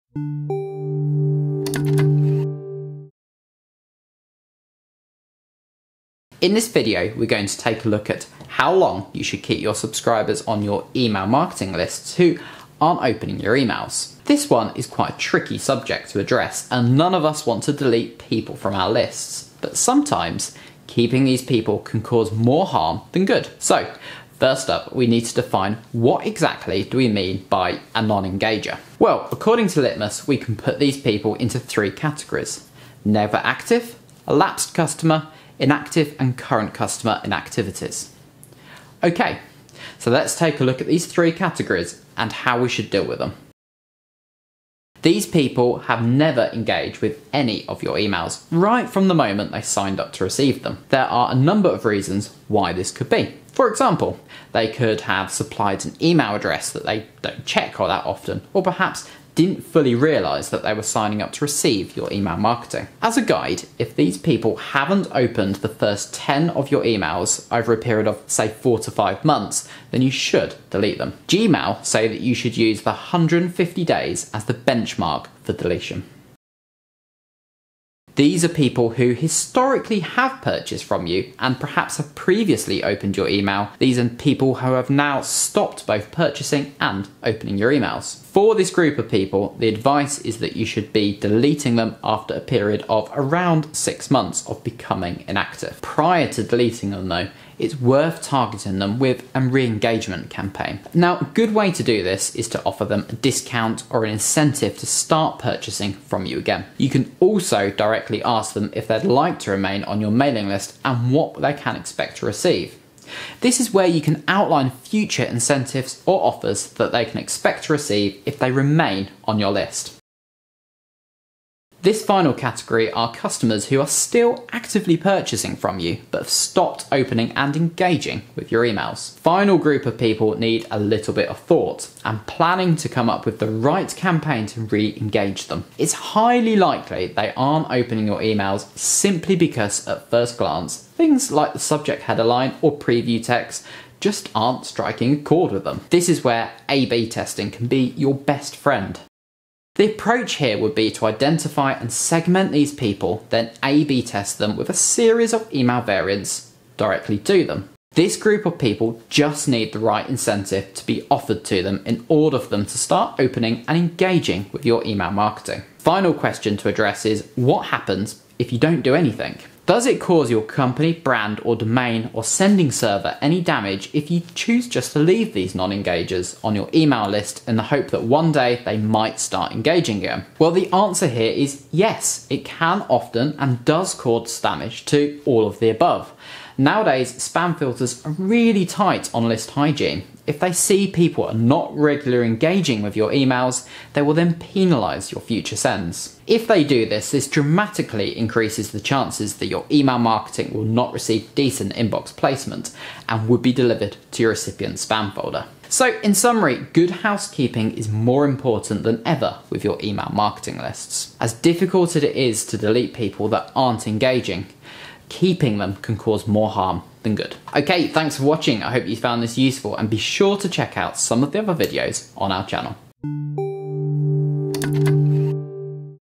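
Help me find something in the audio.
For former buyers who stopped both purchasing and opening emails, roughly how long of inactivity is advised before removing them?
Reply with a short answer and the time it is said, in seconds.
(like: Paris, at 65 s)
6 months, at 93 s.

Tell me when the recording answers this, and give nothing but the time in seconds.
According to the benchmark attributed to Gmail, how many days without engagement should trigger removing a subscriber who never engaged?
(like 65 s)
72 s.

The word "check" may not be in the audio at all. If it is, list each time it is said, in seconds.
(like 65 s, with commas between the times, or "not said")
57 s, 220 s.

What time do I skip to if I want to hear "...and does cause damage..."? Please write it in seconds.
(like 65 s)
183 s.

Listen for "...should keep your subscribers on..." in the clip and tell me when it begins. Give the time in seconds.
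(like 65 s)
9 s.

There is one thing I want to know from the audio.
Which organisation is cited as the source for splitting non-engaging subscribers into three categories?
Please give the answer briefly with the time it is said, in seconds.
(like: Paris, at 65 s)
Litmus, at 29 s.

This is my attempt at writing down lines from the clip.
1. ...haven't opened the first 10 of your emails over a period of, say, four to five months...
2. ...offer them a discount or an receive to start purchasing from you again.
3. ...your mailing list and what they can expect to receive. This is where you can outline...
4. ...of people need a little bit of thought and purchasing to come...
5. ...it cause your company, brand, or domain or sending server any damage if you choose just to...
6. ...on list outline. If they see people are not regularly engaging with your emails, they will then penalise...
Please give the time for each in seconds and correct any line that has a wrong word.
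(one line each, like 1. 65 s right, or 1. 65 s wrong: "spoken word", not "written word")
1. 64 s right
2. 102 s wrong: "incentive", not "receive"
3. 110 s right
4. 129 s wrong: "planning", not "purchasing"
5. 169 s right
6. 189 s wrong: "hygiene", not "outline".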